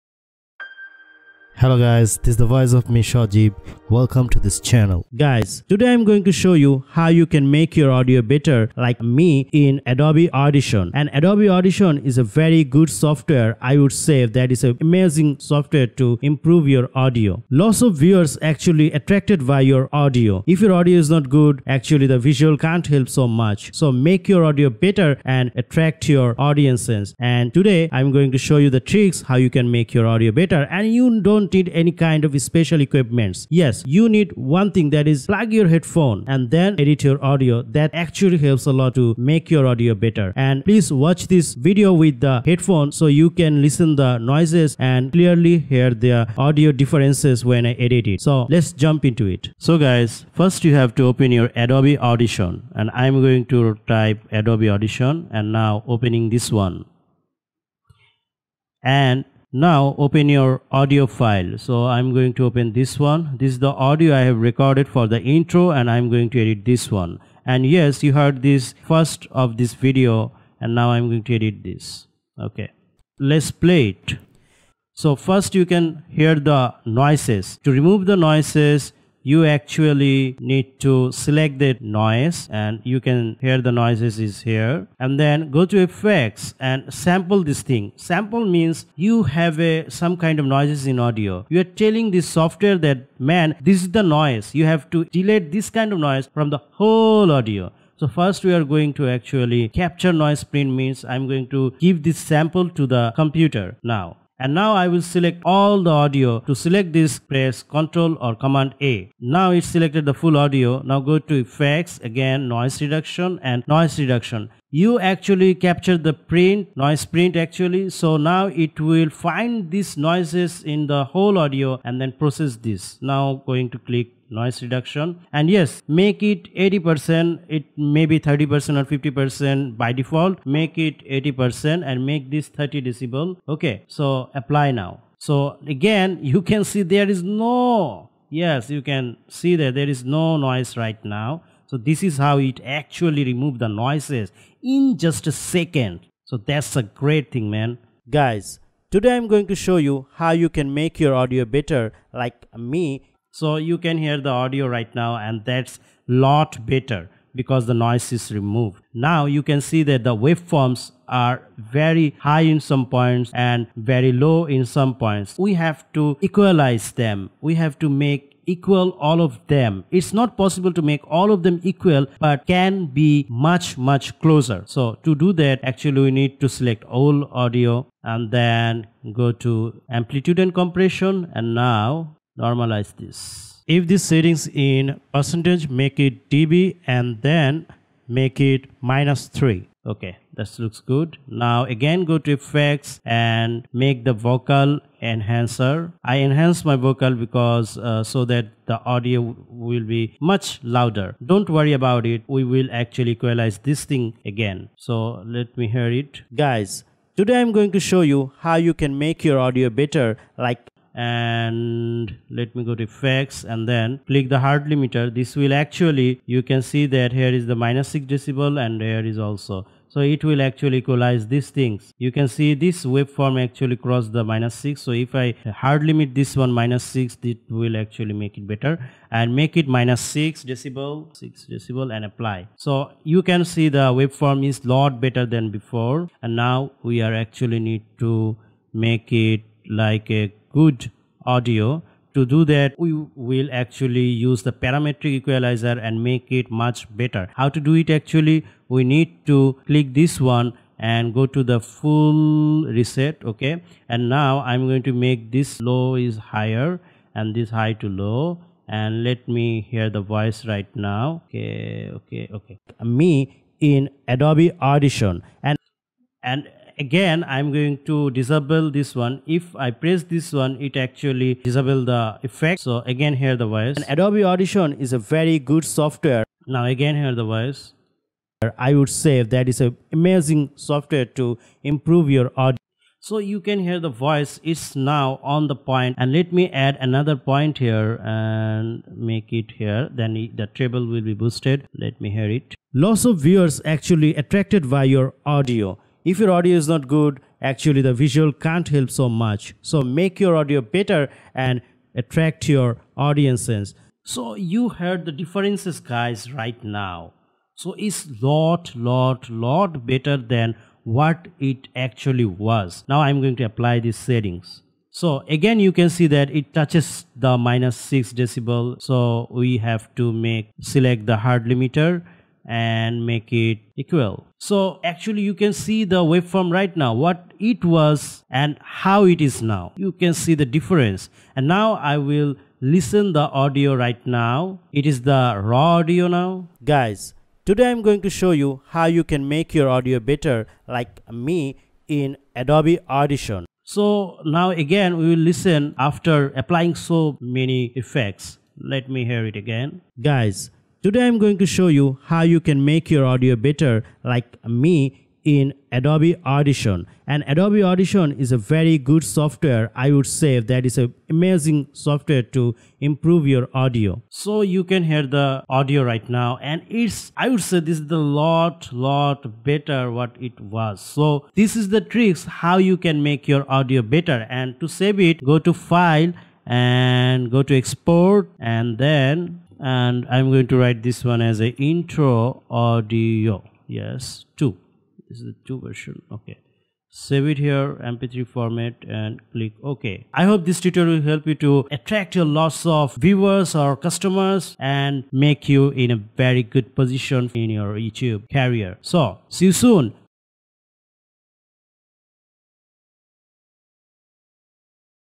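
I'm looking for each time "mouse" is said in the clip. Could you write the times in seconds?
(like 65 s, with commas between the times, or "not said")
not said.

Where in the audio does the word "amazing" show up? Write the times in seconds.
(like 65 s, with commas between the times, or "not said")
14 s, 279 s, 361 s.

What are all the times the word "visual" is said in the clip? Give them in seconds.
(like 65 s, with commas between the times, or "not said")
22 s, 297 s.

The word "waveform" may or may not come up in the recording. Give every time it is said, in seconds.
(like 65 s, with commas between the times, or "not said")
160 s, 222 s, 233 s, 326 s.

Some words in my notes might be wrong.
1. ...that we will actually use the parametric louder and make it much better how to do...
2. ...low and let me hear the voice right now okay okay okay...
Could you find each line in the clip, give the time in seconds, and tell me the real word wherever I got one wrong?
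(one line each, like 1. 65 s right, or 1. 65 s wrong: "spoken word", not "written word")
1. 242 s wrong: "equalizer", not "louder"
2. 257 s right.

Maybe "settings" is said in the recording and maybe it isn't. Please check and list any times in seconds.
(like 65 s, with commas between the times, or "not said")
183 s, 313 s.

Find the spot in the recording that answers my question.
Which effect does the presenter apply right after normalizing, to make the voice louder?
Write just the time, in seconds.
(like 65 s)
194 s.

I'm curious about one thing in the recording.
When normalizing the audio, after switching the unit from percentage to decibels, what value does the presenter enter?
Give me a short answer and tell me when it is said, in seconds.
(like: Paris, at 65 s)
-3, at 188 s.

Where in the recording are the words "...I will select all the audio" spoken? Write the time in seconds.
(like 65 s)
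104 s.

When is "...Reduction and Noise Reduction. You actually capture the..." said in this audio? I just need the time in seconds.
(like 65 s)
112 s.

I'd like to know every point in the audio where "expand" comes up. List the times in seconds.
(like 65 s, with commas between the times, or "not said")
not said.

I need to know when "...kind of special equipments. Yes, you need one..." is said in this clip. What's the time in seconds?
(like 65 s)
31 s.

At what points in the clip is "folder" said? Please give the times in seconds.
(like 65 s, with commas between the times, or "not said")
not said.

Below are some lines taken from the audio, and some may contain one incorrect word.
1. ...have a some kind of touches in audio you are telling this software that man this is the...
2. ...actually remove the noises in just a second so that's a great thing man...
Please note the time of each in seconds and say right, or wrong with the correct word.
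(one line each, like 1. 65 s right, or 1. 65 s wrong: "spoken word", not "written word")
1. 89 s wrong: "noises", not "touches"
2. 142 s right.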